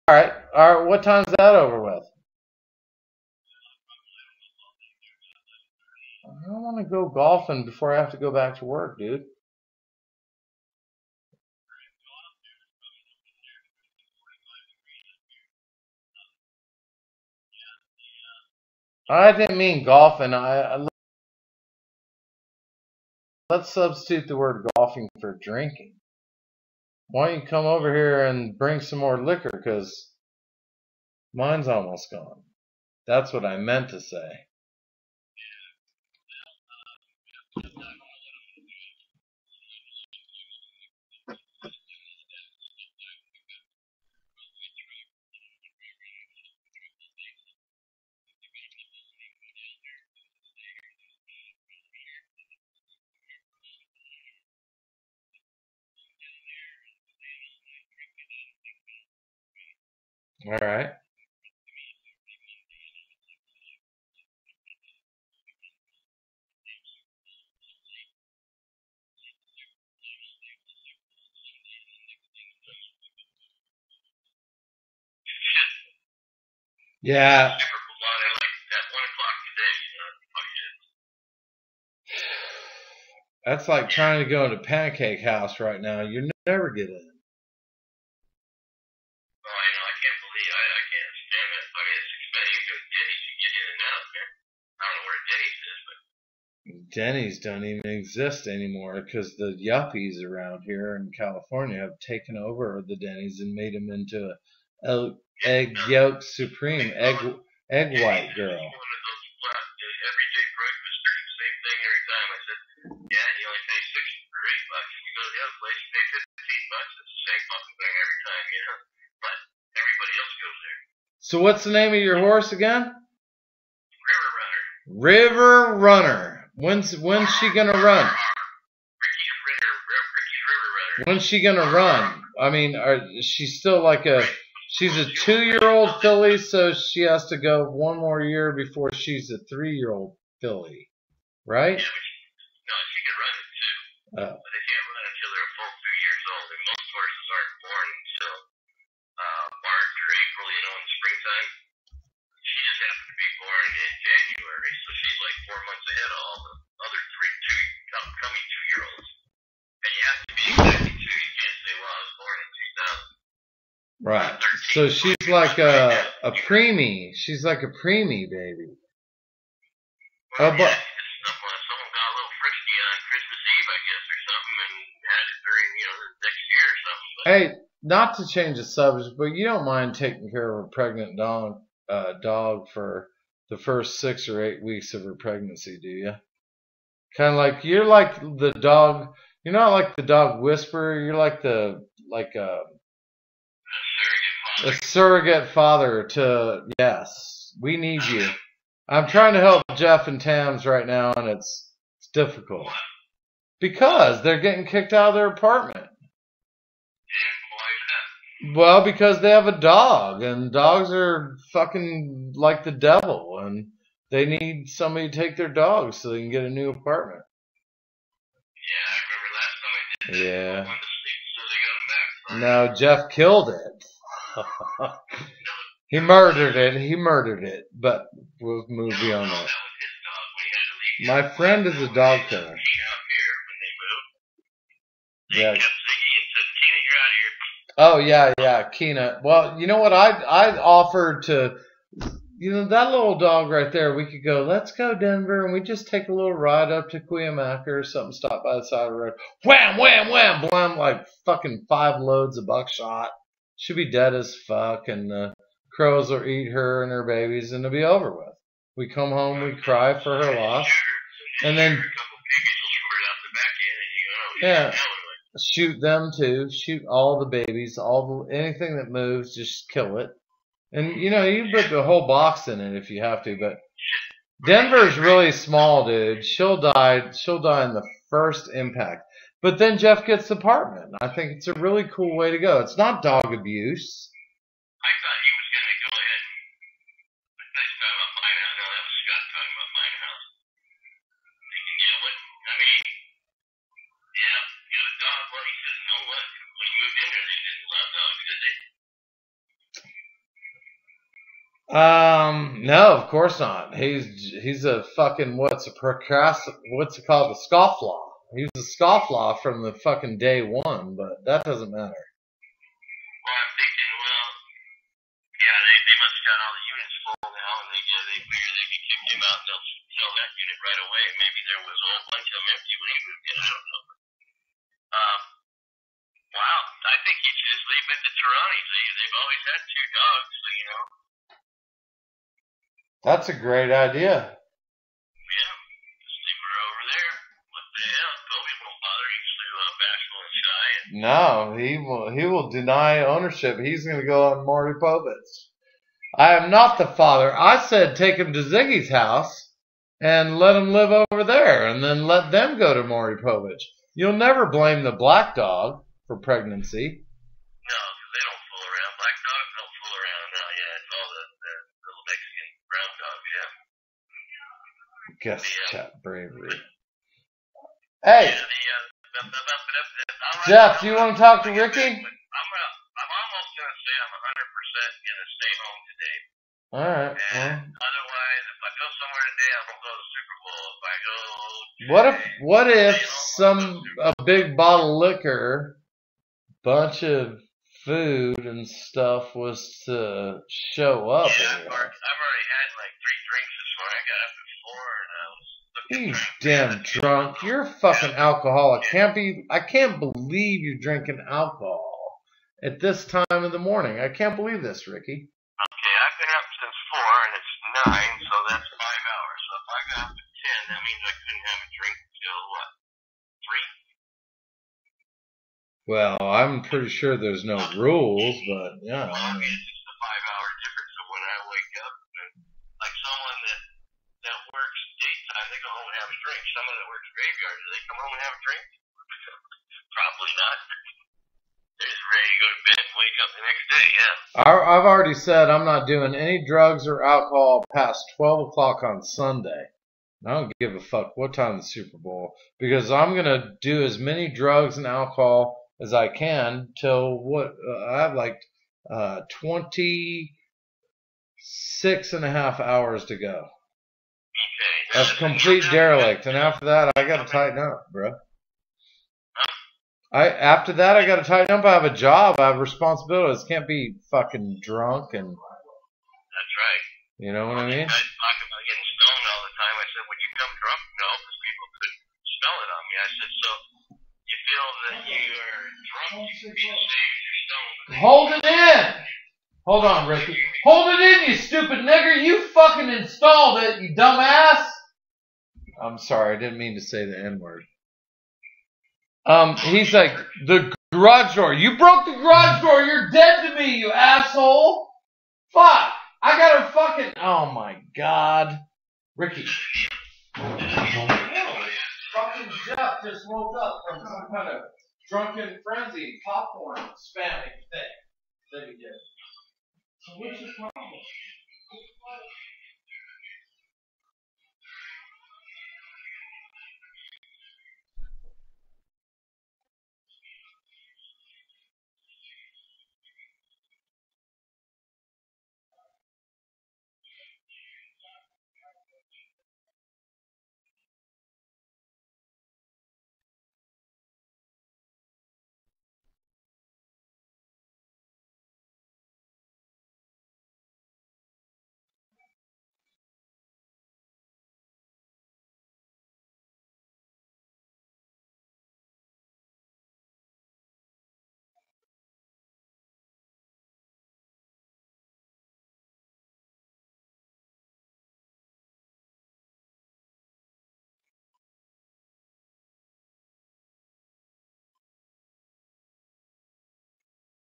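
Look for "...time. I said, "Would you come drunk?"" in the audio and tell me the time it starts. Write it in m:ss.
7:49.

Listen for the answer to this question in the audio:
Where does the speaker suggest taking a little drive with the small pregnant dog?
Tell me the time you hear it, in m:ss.
4:06.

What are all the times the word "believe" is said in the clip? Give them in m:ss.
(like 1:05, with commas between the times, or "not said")
1:30, 6:39, 6:44.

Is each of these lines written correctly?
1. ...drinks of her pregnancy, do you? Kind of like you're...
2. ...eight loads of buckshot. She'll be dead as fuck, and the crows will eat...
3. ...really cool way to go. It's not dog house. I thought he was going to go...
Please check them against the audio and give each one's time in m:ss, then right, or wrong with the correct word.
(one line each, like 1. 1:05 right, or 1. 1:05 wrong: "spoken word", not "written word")
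1. 3:04 wrong: "weeks", not "drinks"
2. 4:11 wrong: "five", not "eight"
3. 4:41 wrong: "abuse", not "house".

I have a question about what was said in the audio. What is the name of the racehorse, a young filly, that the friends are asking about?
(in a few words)
River Runner.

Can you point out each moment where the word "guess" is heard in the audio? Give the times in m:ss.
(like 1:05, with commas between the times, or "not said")
2:53, 6:05.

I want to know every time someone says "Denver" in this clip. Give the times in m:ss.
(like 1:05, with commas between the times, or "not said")
4:04, 4:34.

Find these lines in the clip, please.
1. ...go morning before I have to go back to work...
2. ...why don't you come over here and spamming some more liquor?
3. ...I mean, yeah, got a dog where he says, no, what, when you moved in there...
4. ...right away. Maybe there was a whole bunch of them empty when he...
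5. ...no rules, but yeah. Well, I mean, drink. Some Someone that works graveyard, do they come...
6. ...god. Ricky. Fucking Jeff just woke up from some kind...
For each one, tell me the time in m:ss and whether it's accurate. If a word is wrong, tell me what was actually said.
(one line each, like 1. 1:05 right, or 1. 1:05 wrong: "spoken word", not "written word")
1. 0:06 wrong: "golfing", not "morning"
2. 0:27 wrong: "bring", not "spamming"
3. 4:52 right
4. 5:20 right
5. 6:57 right
6. 8:17 right.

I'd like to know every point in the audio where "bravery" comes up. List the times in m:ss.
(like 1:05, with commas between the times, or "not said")
6:06.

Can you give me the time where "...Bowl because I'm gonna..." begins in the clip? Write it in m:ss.
7:21.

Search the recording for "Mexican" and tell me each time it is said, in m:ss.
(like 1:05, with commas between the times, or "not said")
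6:02.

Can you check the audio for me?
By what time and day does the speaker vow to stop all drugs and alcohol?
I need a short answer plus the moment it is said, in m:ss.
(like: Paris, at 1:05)
12 o'clock on Sunday, at 7:18.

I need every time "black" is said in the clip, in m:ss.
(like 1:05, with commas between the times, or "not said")
5:54, 5:58.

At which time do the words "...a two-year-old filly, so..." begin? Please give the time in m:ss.
2:14.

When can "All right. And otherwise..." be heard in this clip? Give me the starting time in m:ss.
6:16.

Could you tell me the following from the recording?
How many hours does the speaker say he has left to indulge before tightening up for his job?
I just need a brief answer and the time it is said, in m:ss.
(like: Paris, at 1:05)
26.5, at 7:29.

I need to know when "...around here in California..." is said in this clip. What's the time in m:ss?
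1:40.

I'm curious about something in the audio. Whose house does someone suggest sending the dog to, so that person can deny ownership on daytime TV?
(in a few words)
Ziggy's.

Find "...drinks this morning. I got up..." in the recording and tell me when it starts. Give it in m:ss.
6:33.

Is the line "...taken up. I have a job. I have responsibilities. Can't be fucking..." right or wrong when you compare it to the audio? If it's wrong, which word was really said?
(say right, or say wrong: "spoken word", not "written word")
wrong: "tighten", not "taken".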